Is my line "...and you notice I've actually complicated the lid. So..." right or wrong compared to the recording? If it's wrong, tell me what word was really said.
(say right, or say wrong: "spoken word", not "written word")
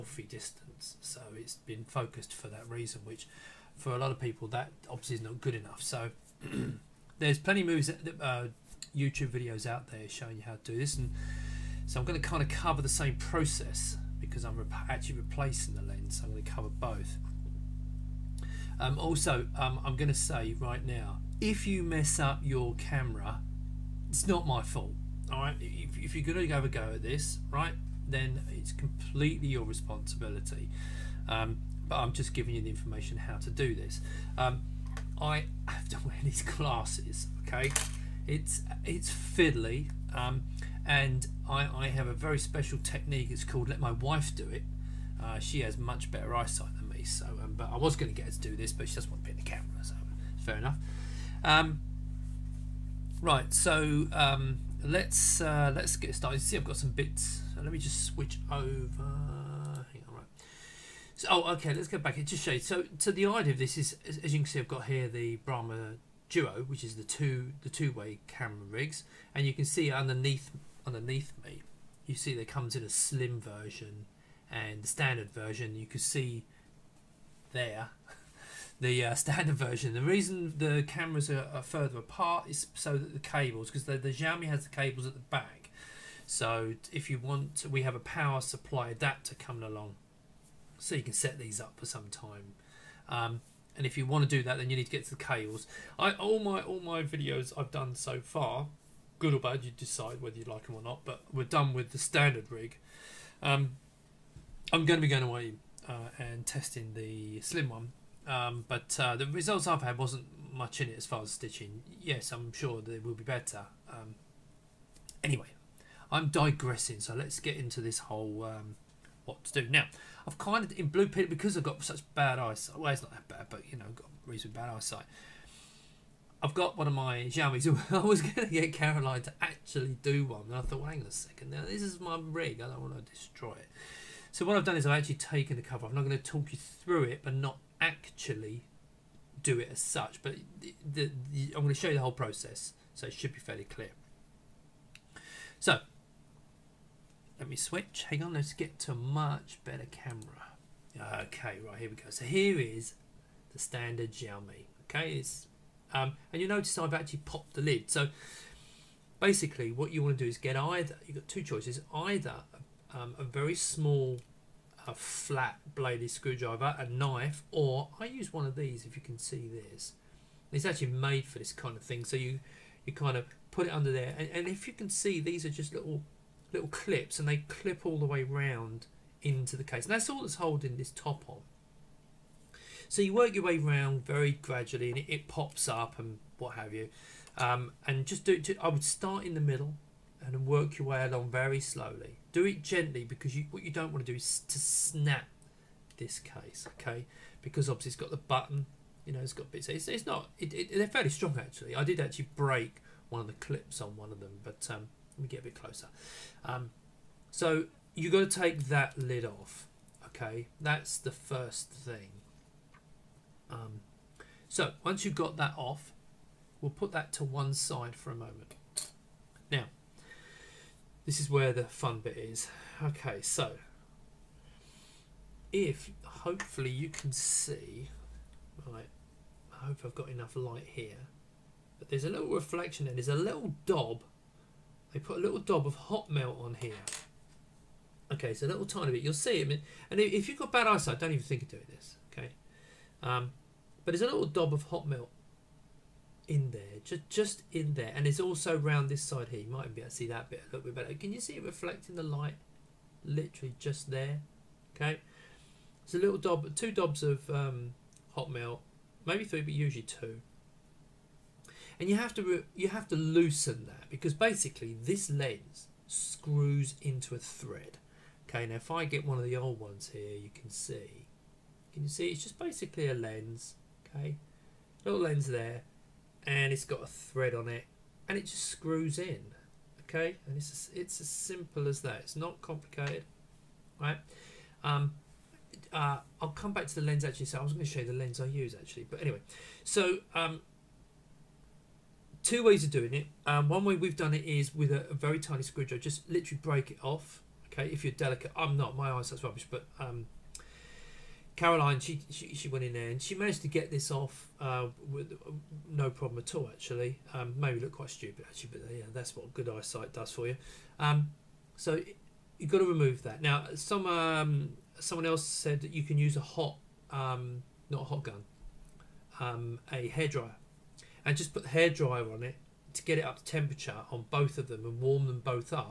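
wrong: "popped", not "complicated".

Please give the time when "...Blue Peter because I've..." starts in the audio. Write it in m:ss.
2:00.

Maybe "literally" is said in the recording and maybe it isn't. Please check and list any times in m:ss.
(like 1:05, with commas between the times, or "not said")
4:13, 4:56.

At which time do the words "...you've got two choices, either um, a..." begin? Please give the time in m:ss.
2:41.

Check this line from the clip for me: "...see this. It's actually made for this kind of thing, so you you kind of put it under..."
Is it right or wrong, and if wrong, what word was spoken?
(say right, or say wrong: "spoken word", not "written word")
right.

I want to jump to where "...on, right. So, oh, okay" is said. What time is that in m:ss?
1:00.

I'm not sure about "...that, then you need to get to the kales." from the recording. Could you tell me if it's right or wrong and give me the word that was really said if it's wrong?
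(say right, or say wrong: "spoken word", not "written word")
right.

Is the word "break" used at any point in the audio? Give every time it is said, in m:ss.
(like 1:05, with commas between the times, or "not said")
3:22, 4:56.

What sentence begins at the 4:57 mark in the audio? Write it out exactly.
Okay, if you're delicate, I'm not.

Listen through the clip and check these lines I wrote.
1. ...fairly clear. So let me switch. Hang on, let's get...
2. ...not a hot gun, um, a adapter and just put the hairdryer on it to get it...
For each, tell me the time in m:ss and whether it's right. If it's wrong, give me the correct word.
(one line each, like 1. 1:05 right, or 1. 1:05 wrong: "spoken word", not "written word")
1. 2:23 right
2. 5:17 wrong: "hairdryer", not "adapter".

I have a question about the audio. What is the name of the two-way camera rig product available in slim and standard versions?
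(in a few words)
Brahma Duo.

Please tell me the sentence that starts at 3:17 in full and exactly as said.
Because obviously it's got the button, you know, it's got bits.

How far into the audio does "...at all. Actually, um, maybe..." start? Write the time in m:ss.
5:06.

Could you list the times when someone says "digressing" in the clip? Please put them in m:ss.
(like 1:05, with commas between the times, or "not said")
1:56.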